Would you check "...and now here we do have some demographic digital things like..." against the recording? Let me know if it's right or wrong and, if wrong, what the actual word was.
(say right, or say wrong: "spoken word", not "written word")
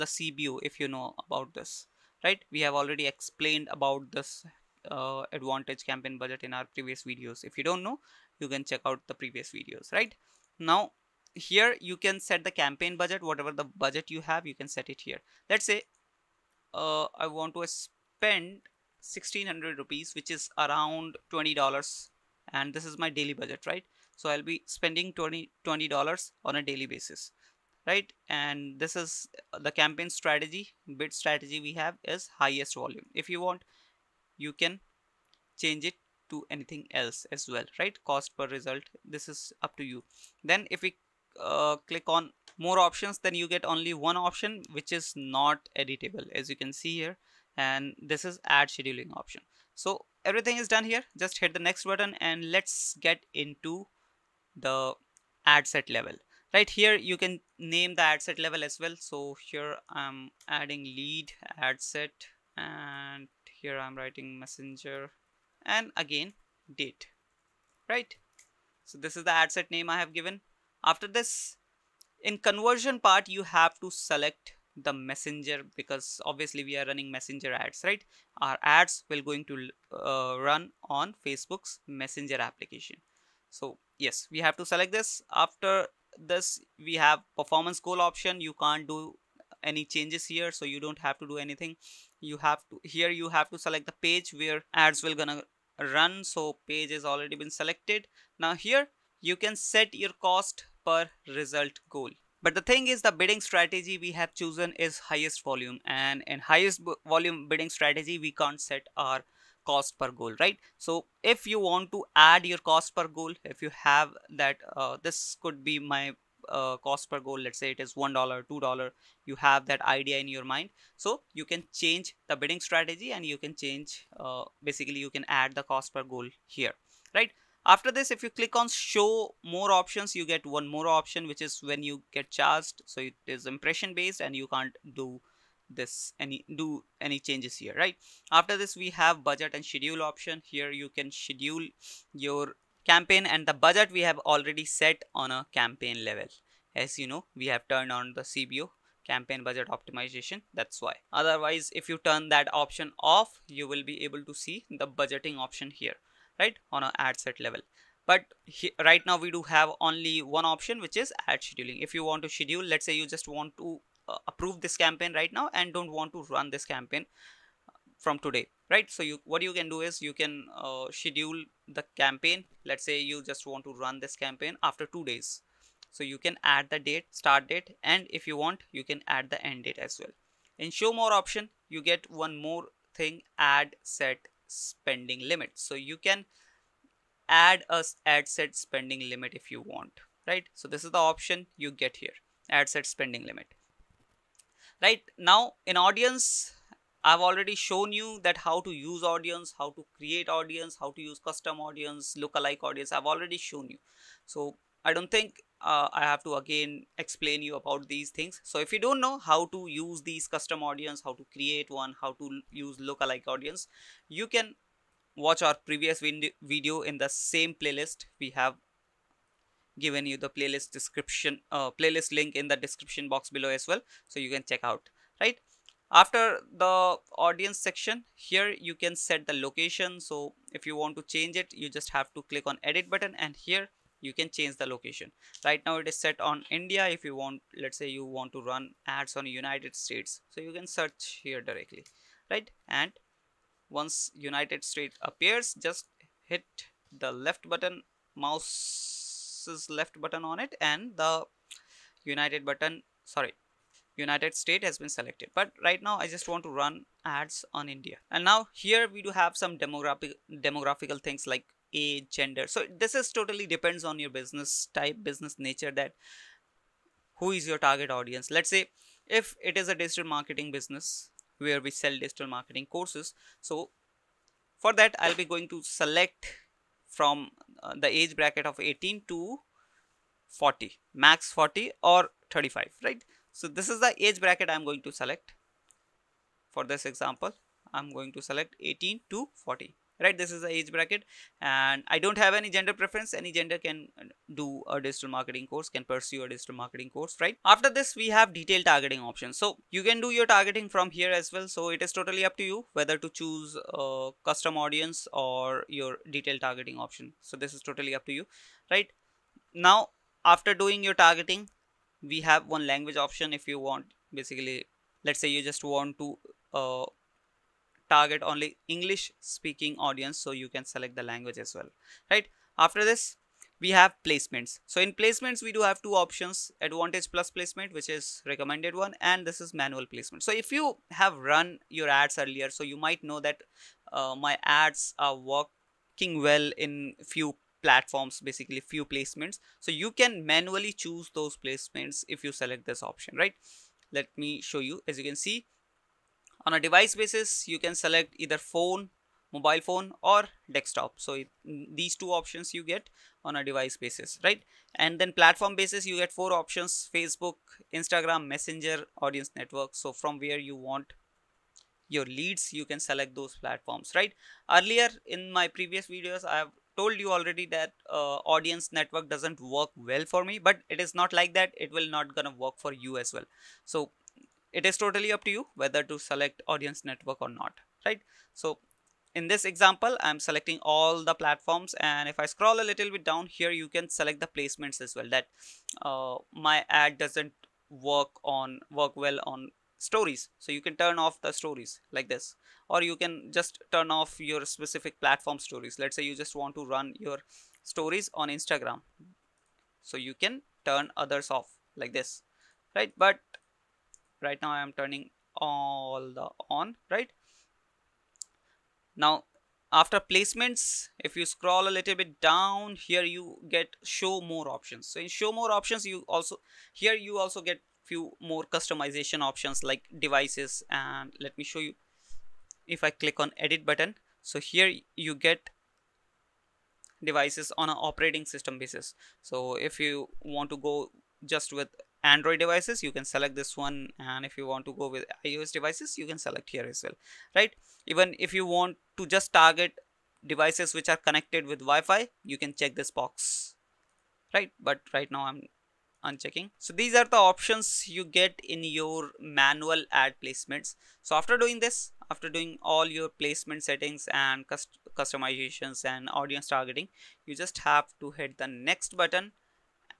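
wrong: "demographical", not "digital".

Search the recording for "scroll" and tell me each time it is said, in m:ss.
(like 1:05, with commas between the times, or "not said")
6:22, 6:51.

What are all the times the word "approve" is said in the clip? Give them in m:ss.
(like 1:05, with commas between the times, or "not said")
2:44.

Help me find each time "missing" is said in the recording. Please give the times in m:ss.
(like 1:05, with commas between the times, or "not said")
not said.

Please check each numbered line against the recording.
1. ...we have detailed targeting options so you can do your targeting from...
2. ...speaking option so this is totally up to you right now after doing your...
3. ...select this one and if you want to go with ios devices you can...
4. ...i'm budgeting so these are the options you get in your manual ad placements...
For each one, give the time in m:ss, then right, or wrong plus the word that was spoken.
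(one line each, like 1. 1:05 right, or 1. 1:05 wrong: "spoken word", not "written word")
1. 4:57 right
2. 5:06 wrong: "targeting", not "speaking"
3. 7:13 right
4. 7:25 wrong: "unchecking", not "budgeting".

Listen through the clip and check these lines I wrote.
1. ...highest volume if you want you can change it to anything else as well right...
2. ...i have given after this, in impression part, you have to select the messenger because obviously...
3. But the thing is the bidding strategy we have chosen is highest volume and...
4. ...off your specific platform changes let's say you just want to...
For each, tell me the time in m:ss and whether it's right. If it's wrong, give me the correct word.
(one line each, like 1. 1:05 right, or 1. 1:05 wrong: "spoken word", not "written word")
1. 0:32 right
2. 1:09 wrong: "conversion", not "impression"
3. 1:42 right
4. 6:33 wrong: "stories", not "changes".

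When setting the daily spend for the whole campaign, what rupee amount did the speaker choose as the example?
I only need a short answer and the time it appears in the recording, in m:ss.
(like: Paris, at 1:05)
1600 rupees, at 0:19.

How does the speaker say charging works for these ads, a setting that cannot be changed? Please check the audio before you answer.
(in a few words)
Impression based.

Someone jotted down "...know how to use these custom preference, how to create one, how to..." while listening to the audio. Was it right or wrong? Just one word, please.
wrong.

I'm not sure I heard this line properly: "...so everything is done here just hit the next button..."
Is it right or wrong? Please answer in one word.
right.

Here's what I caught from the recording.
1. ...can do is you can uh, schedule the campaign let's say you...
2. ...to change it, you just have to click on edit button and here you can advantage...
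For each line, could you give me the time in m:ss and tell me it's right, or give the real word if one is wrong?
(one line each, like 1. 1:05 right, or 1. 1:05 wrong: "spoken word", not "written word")
1. 2:49 right
2. 3:50 wrong: "change", not "advantage".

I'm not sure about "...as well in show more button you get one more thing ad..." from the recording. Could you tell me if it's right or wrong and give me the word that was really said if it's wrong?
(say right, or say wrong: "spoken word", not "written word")
wrong: "option", not "button".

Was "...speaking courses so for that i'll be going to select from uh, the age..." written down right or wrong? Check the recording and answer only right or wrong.
wrong.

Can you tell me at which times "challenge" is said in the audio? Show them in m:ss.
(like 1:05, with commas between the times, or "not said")
not said.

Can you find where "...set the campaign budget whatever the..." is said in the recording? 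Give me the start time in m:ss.
0:12.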